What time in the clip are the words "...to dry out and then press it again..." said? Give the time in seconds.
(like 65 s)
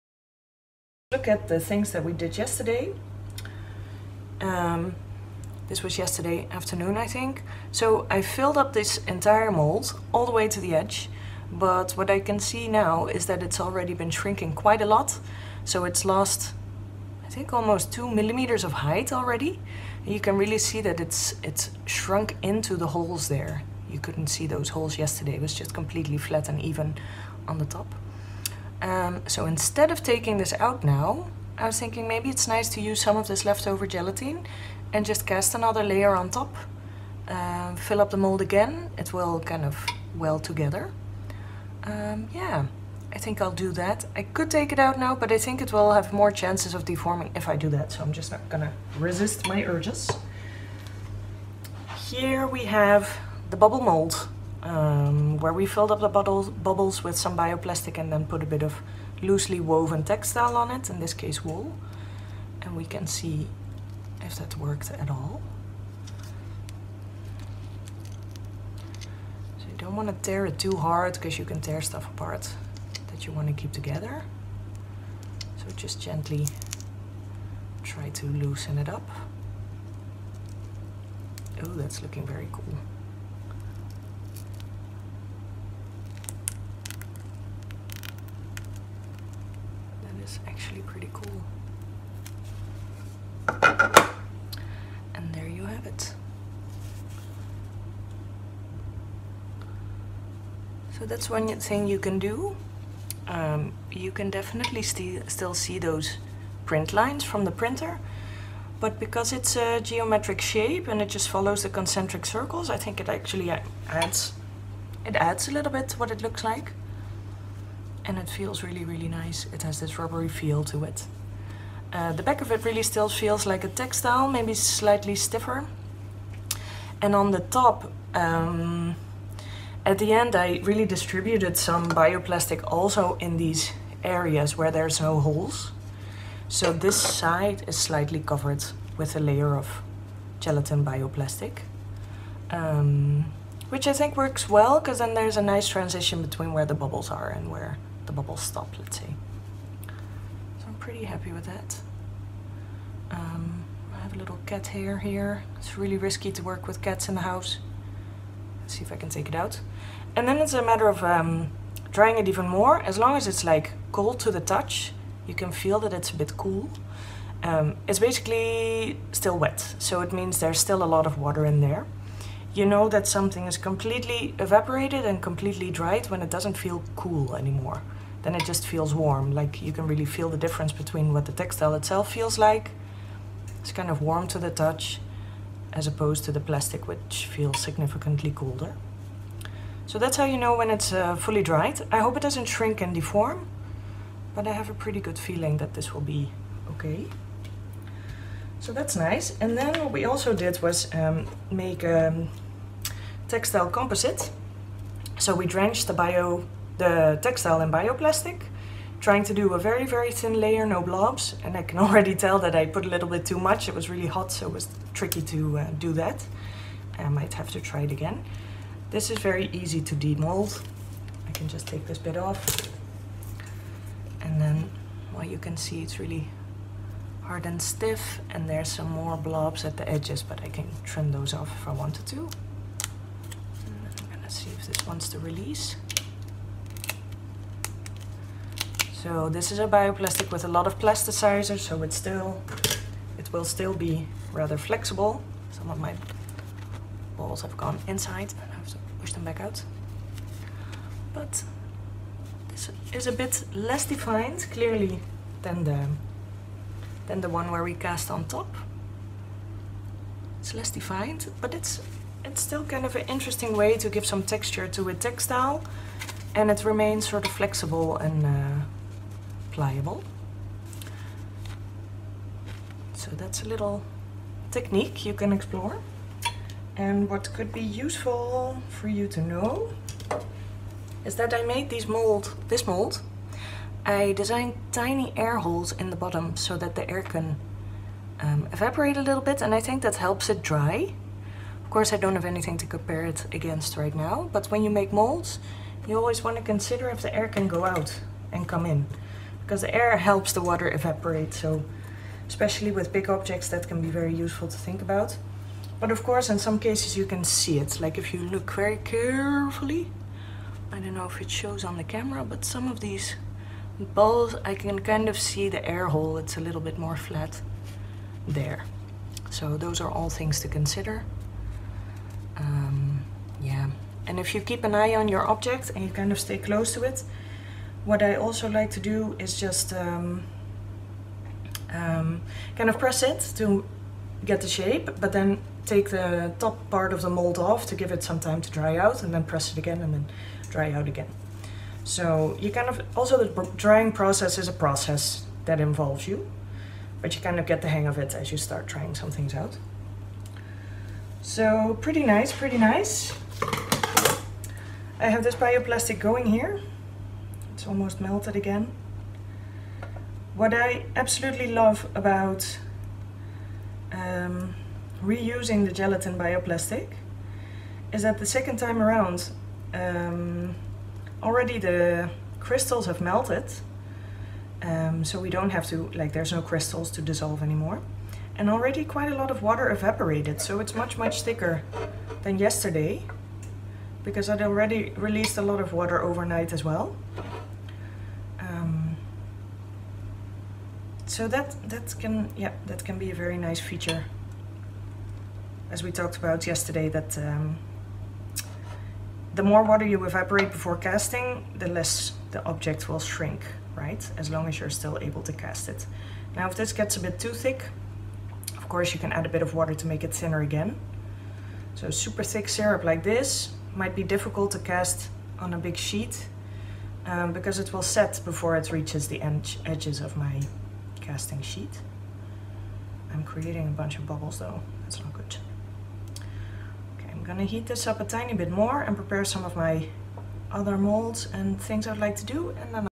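338 s.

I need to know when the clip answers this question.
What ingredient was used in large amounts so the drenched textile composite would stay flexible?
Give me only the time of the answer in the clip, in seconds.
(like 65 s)
240 s.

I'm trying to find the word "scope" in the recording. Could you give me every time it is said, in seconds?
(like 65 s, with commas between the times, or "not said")
not said.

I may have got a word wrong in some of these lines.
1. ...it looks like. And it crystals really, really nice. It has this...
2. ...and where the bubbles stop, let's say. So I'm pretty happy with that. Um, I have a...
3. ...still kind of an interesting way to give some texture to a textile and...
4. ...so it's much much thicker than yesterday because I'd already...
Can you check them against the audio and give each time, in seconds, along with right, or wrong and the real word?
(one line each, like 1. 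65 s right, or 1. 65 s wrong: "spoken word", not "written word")
1. 116 s wrong: "feels", not "crystals"
2. 147 s right
3. 262 s right
4. 380 s right.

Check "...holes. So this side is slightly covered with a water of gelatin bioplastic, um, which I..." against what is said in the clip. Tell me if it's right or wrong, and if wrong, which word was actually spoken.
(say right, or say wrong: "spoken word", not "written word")
wrong: "layer", not "water".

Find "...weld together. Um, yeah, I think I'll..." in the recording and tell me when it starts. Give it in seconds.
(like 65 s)
40 s.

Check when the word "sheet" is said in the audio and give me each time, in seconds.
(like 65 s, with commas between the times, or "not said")
415 s, 421 s.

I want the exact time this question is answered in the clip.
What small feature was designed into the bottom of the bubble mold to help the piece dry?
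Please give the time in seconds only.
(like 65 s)
284 s.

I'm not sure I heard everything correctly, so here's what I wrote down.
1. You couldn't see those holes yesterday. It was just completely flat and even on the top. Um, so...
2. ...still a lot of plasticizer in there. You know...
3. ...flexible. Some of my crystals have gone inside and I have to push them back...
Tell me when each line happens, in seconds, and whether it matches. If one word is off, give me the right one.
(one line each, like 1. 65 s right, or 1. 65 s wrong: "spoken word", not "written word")
1. 23 s right
2. 170 s wrong: "water", not "plasticizer"
3. 244 s wrong: "balls", not "crystals".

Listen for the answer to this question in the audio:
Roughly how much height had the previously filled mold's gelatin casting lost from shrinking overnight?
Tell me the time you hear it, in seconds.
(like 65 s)
17 s.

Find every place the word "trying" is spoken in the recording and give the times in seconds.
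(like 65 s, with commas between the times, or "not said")
209 s, 348 s.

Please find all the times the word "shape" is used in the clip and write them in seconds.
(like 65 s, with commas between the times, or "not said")
110 s, 334 s.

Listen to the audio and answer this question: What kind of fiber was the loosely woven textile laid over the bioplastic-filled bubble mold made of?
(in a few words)
wool.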